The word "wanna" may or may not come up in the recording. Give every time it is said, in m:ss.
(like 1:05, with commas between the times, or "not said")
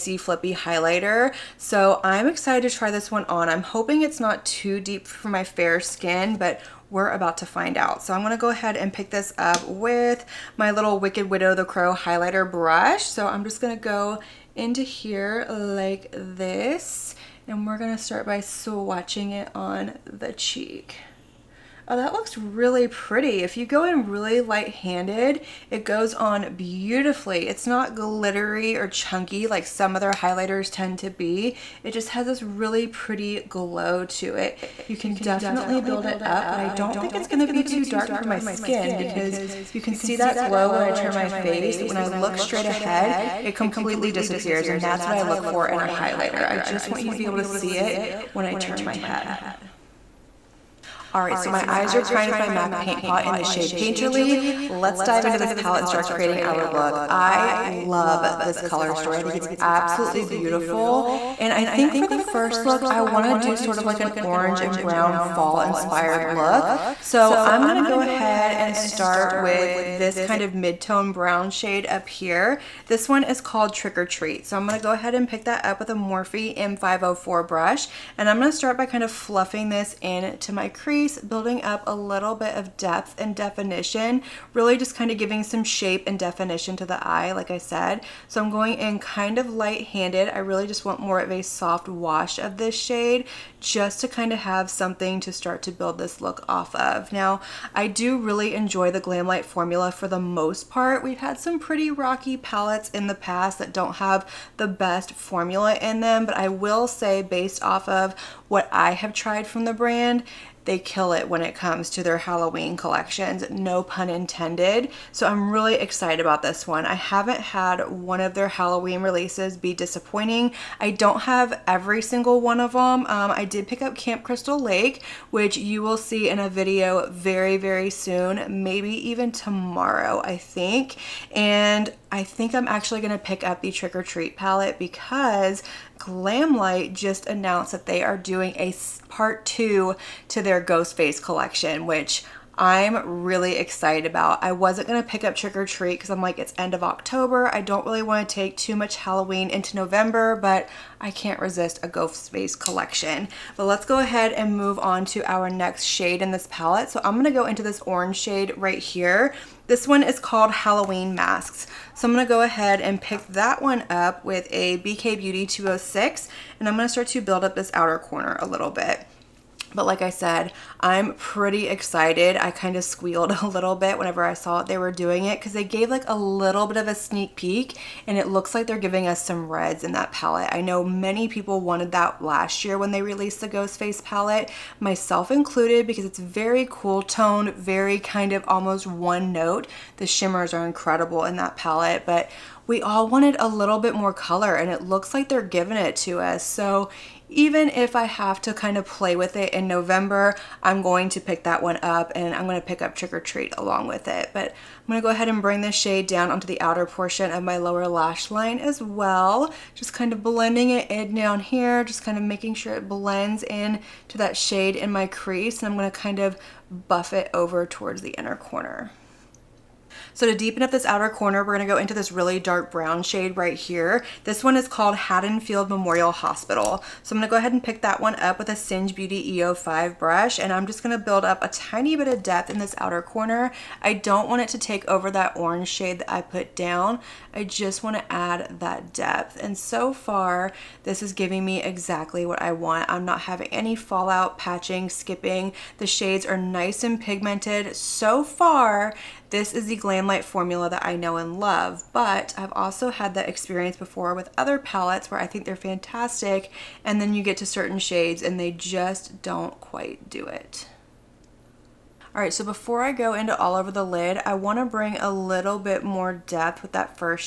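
3:57, 4:24.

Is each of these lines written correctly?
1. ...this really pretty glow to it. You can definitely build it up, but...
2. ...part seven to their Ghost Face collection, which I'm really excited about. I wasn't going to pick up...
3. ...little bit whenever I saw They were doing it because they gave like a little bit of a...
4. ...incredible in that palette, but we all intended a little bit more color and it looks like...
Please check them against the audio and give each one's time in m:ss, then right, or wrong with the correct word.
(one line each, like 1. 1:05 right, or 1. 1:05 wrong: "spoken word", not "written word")
1. 0:32 right
2. 2:19 wrong: "two", not "seven"
3. 2:53 right
4. 3:10 wrong: "wanted", not "intended".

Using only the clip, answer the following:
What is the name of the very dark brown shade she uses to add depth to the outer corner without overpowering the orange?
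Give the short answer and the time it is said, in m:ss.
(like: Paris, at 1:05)
Haddonfield Memorial Hospital, at 3:44.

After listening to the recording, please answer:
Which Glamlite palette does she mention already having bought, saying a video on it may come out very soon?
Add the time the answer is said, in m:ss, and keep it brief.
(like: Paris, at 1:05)
Camp Crystal Lake, at 2:03.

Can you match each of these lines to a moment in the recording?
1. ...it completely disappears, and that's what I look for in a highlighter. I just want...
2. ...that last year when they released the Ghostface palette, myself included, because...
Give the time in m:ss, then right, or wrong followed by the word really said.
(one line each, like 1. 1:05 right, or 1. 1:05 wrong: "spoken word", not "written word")
1. 0:43 right
2. 3:01 right.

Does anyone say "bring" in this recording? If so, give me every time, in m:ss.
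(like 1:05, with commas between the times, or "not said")
3:25, 4:24.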